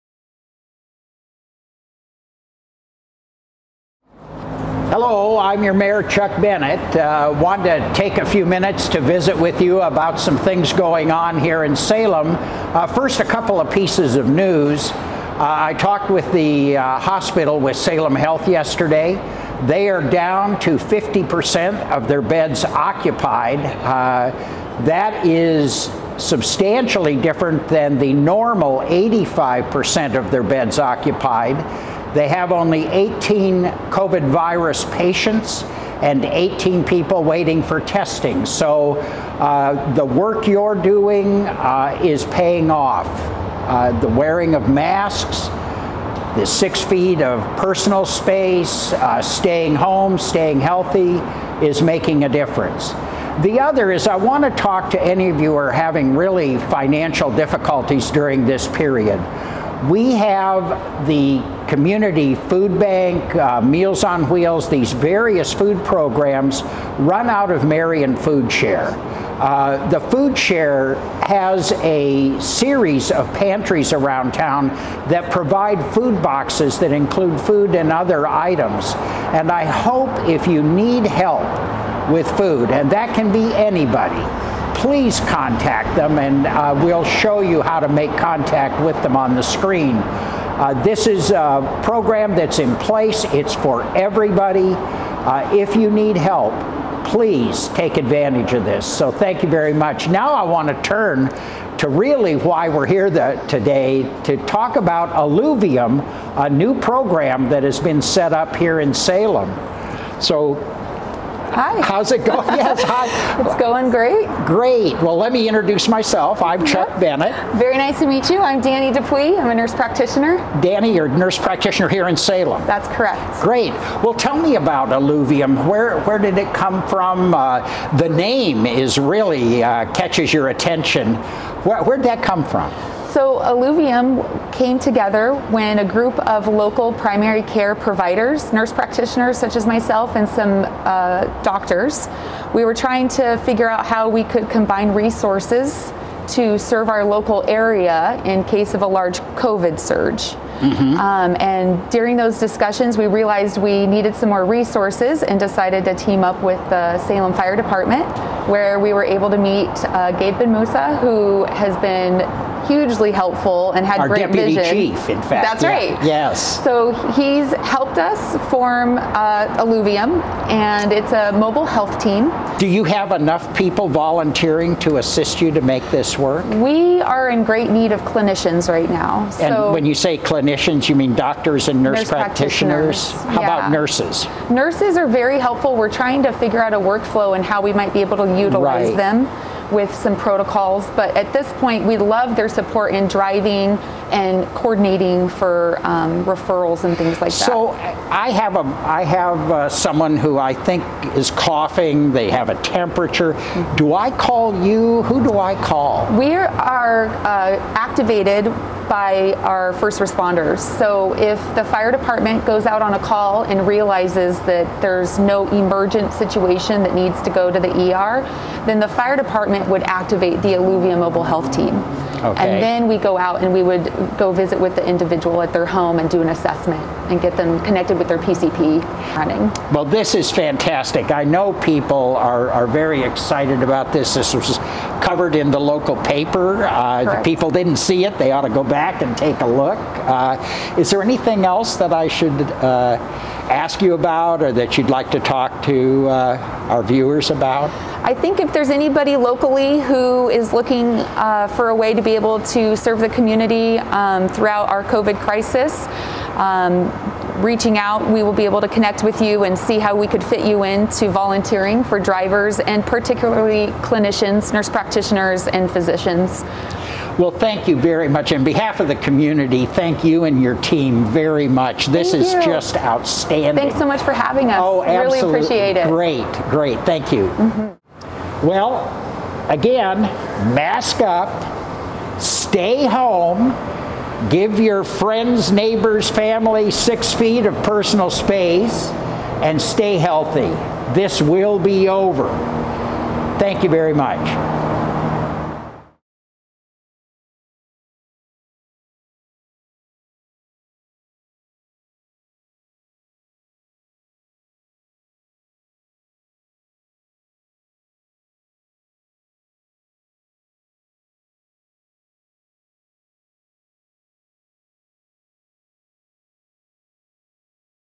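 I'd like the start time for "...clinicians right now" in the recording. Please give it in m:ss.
2:58.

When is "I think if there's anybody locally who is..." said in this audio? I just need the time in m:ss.
4:08.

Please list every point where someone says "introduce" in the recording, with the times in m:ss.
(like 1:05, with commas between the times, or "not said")
1:55.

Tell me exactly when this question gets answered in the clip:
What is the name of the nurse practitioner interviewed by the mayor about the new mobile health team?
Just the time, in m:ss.
1:58.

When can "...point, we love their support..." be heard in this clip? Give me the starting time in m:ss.
3:11.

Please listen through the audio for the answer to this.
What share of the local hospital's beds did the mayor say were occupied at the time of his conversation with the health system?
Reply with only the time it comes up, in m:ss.
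0:20.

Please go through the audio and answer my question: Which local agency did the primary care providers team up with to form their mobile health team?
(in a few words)
Salem Fire Department.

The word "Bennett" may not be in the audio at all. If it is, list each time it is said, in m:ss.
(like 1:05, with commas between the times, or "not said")
0:06, 1:57.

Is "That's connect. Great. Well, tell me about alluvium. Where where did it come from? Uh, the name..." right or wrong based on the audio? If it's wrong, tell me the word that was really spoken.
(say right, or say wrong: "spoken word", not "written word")
wrong: "correct", not "connect".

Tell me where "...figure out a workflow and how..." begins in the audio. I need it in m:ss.
3:06.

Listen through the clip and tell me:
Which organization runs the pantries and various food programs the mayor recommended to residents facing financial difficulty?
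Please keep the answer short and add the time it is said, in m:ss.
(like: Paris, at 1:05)
Marion Food Share, at 1:07.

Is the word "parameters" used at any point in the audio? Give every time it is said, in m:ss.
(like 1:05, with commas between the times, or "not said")
not said.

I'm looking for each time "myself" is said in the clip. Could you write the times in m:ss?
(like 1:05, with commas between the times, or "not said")
1:55, 2:19.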